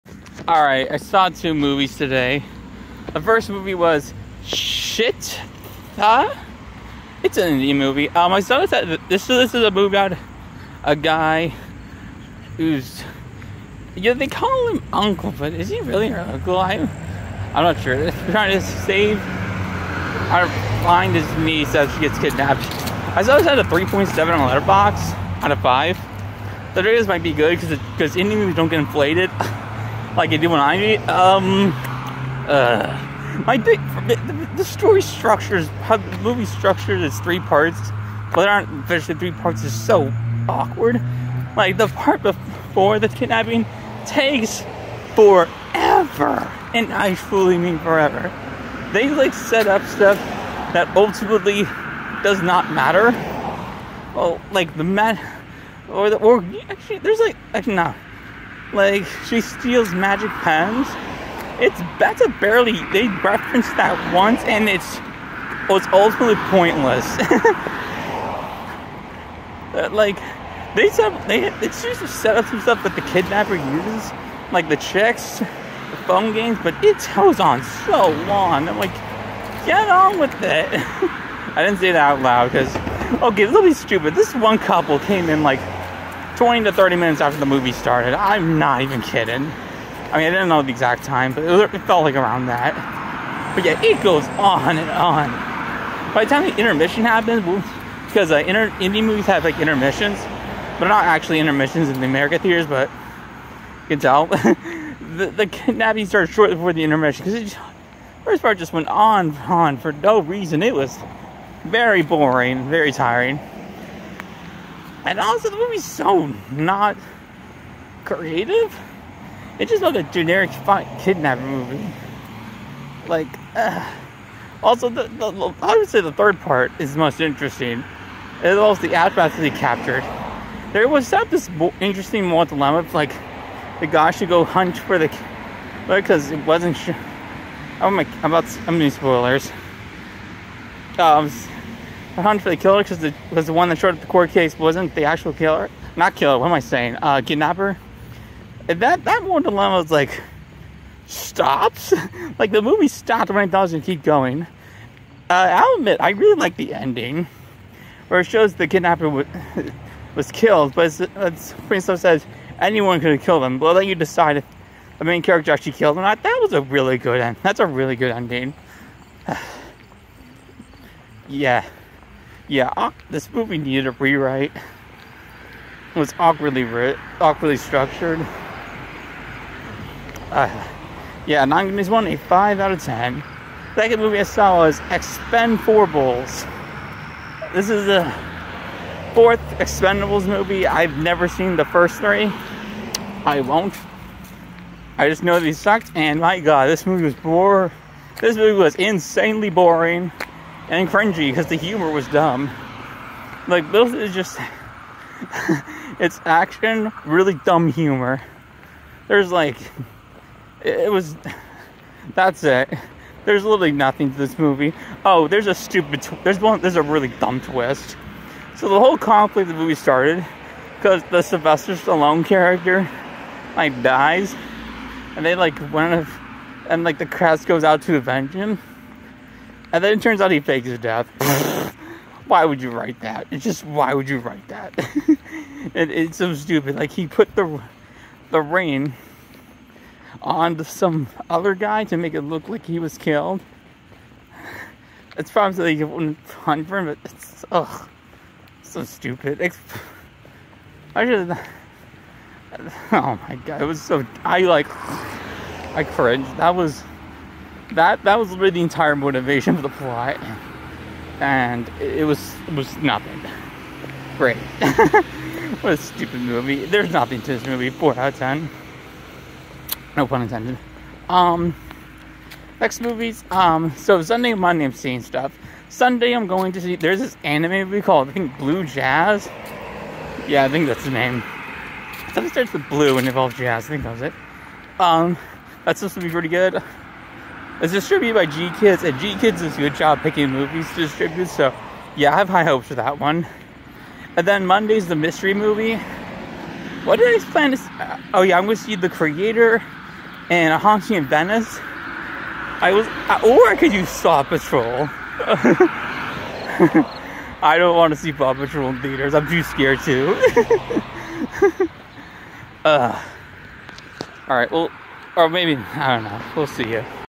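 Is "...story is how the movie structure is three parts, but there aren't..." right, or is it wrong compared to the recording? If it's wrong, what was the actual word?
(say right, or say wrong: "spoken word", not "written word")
right.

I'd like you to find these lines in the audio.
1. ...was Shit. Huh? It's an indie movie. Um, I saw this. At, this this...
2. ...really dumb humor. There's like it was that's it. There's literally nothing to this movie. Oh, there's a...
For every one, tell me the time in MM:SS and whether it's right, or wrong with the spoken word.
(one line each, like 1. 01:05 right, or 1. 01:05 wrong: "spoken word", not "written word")
1. 00:03 right
2. 03:27 right.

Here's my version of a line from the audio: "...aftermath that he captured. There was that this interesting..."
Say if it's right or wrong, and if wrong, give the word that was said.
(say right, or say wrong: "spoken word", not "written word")
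right.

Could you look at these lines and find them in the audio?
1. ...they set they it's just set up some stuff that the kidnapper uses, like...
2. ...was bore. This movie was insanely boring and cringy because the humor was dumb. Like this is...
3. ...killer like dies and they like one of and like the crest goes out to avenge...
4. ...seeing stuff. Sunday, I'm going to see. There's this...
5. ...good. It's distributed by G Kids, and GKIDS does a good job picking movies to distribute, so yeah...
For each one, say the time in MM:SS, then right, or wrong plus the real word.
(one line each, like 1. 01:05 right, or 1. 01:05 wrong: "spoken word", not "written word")
1. 01:10 right
2. 03:17 right
3. 03:42 wrong: "character", not "killer"
4. 04:34 right
5. 04:46 right.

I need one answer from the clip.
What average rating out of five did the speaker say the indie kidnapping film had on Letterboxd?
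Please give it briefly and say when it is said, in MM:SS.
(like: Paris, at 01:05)
3.7, at 00:23.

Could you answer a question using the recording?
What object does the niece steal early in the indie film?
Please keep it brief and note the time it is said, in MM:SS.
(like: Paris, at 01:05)
Magic pens, at 00:59.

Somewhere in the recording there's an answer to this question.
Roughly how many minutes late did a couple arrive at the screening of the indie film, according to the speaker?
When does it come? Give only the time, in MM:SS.
01:26.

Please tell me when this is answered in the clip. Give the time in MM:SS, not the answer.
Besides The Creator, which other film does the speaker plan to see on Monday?
05:00.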